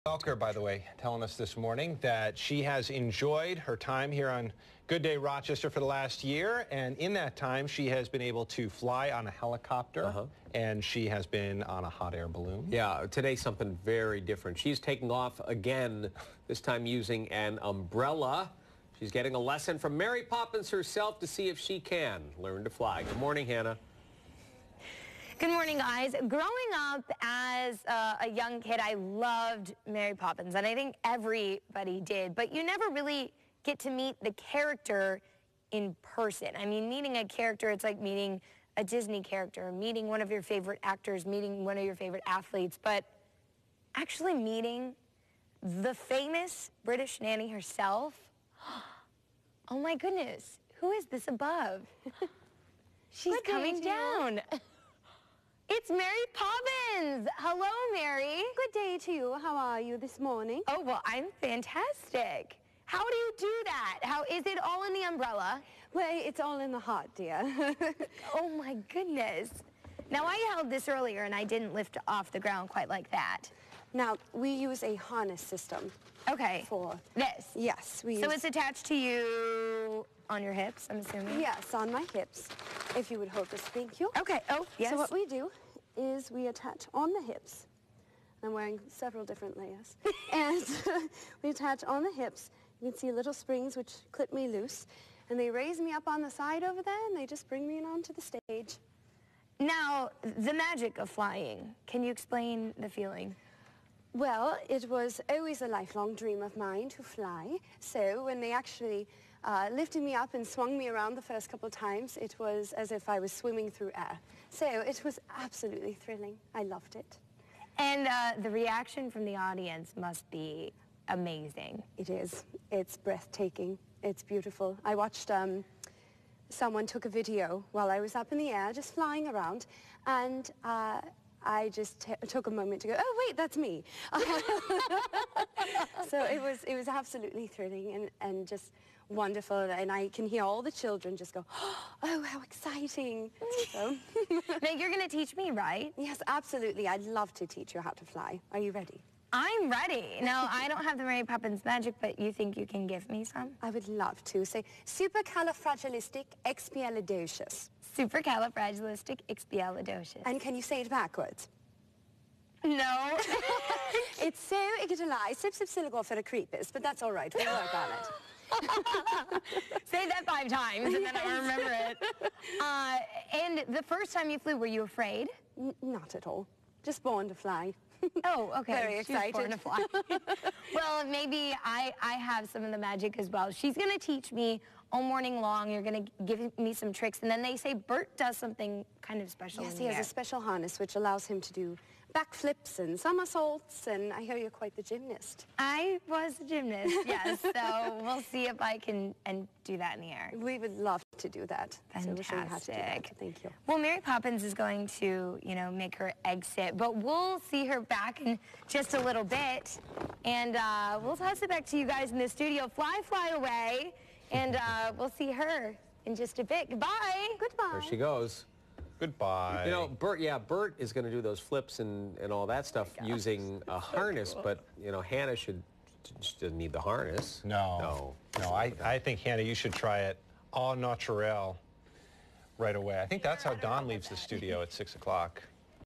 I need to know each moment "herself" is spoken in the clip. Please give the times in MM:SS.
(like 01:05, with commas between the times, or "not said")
00:20, 00:47.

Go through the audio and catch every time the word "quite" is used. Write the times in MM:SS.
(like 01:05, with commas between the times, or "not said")
01:12, 03:14.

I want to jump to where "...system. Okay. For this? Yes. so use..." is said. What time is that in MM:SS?
01:15.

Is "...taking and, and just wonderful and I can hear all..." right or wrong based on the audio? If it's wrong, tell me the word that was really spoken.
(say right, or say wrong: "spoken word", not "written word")
wrong: "thrilling", not "taking".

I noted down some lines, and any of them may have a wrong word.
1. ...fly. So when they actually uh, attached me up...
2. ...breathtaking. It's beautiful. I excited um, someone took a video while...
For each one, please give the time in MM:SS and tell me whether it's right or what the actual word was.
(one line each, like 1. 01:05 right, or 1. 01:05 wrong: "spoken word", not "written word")
1. 01:47 wrong: "lifted", not "attached"
2. 02:02 wrong: "watched", not "excited".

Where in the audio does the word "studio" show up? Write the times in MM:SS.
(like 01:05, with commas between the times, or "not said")
03:32, 03:54.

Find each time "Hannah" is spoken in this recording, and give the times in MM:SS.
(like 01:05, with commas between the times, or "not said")
00:23, 03:45, 03:49.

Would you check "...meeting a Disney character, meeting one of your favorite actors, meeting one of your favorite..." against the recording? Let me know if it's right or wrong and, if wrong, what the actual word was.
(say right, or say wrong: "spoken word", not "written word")
right.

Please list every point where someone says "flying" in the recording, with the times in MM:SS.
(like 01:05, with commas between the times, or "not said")
01:41, 02:08.